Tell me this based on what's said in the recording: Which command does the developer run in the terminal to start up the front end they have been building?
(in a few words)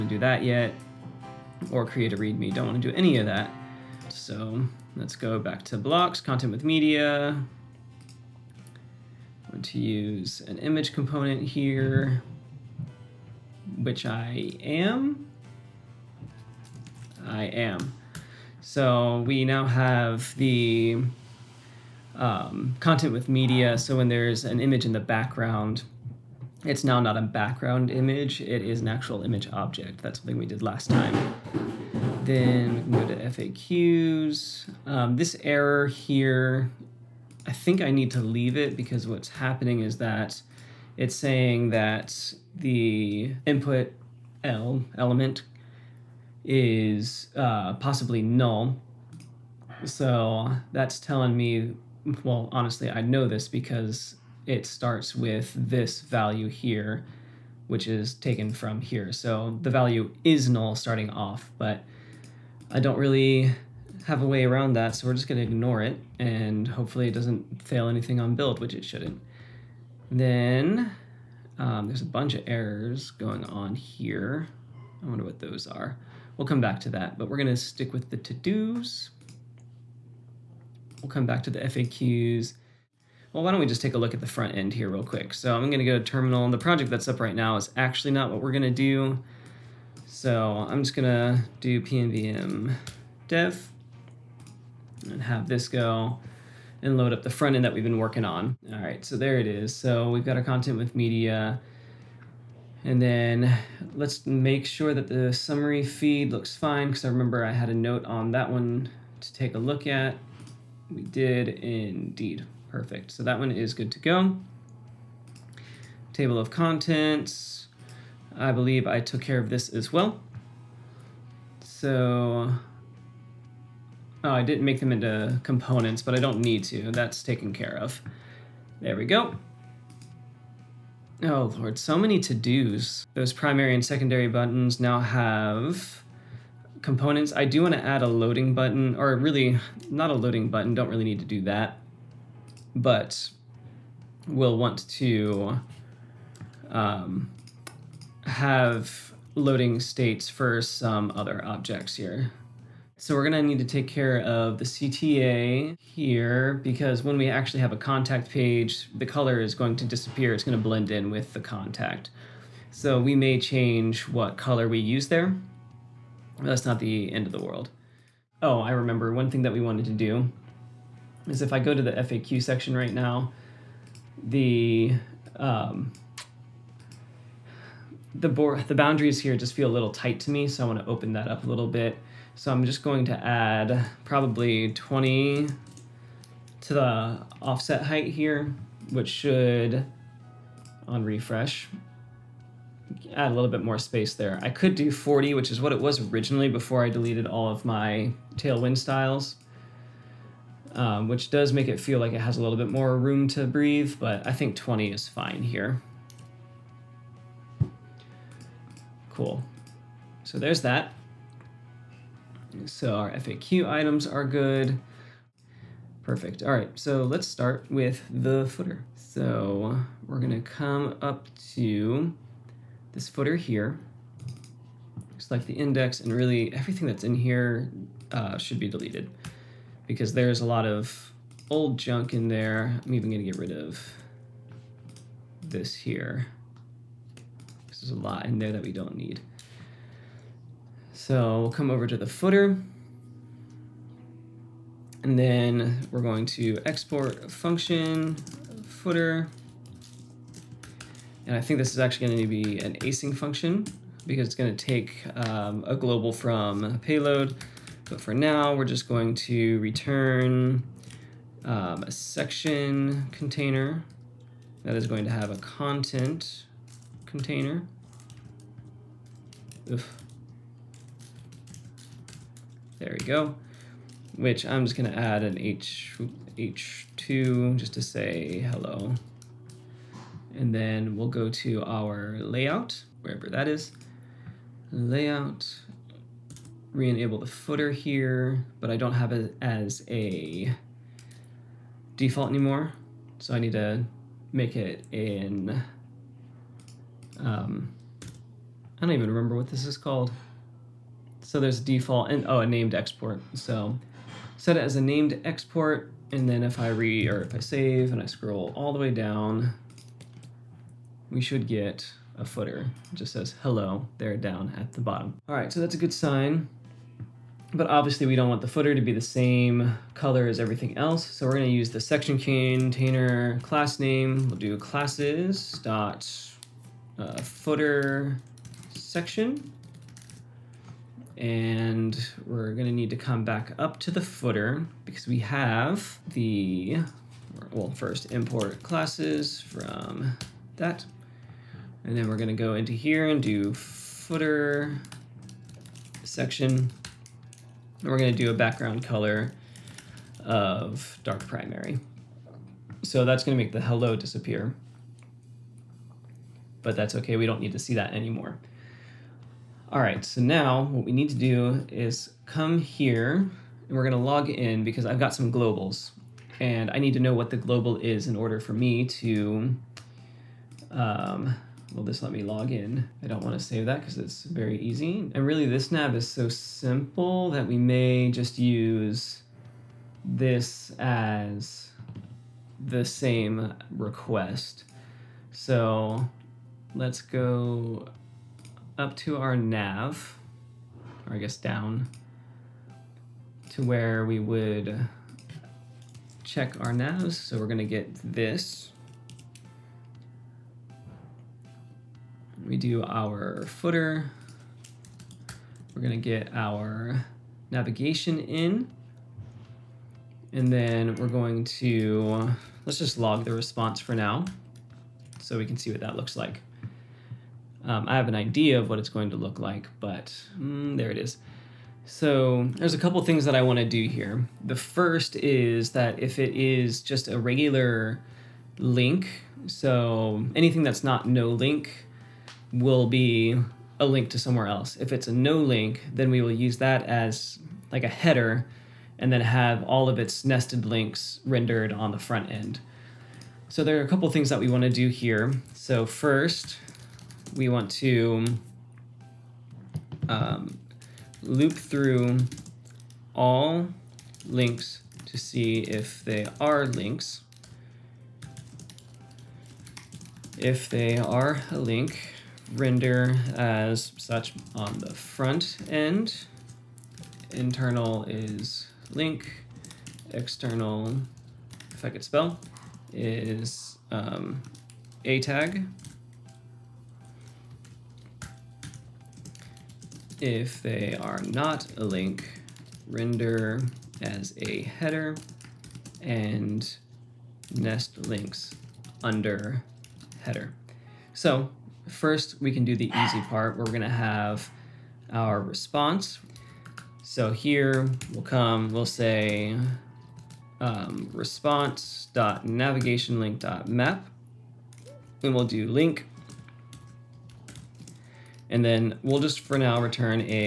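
pnpm dev.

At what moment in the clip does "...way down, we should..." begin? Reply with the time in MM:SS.
05:08.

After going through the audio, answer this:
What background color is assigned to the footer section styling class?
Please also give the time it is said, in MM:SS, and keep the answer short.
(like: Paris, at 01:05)
dark primary, at 05:51.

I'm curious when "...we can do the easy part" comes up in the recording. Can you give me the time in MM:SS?
08:12.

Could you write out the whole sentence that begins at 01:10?
Then um, there's a bunch of errors going on here.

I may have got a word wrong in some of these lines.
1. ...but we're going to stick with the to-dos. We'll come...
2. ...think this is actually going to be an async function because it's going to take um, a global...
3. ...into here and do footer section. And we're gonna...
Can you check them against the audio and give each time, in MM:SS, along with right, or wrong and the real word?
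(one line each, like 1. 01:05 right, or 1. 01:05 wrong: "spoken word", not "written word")
1. 01:17 right
2. 04:11 right
3. 05:42 right.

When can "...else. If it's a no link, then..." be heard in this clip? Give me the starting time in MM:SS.
07:14.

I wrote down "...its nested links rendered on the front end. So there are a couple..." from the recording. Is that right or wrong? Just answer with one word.
right.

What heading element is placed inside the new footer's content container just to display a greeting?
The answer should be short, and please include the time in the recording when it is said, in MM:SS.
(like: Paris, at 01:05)
H2, at 04:36.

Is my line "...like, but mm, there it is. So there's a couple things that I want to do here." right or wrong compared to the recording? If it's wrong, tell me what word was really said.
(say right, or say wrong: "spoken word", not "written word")
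right.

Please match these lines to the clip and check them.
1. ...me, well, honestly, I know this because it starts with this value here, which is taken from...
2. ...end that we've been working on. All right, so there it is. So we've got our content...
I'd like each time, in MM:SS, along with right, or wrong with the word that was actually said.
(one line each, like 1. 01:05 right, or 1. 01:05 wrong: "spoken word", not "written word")
1. 00:51 right
2. 01:37 right.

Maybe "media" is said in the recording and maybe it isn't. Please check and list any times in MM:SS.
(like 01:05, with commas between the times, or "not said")
00:06, 00:23, 01:40.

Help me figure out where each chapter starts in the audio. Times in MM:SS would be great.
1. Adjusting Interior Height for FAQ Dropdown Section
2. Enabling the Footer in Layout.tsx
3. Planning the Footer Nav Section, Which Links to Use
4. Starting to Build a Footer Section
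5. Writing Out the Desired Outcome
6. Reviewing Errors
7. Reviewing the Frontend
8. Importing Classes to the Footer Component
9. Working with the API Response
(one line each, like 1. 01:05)
1. 02:47
2. 04:42
3. 06:36
4. 03:34
5. 07:24
6. 01:09
7. 02:04
8. 05:35
9. 08:12.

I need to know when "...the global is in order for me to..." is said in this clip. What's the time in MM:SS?
06:07.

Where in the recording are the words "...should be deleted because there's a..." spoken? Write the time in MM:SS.
03:48.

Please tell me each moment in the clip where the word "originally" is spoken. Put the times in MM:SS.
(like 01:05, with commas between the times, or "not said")
03:16.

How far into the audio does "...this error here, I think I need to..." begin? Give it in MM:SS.
00:35.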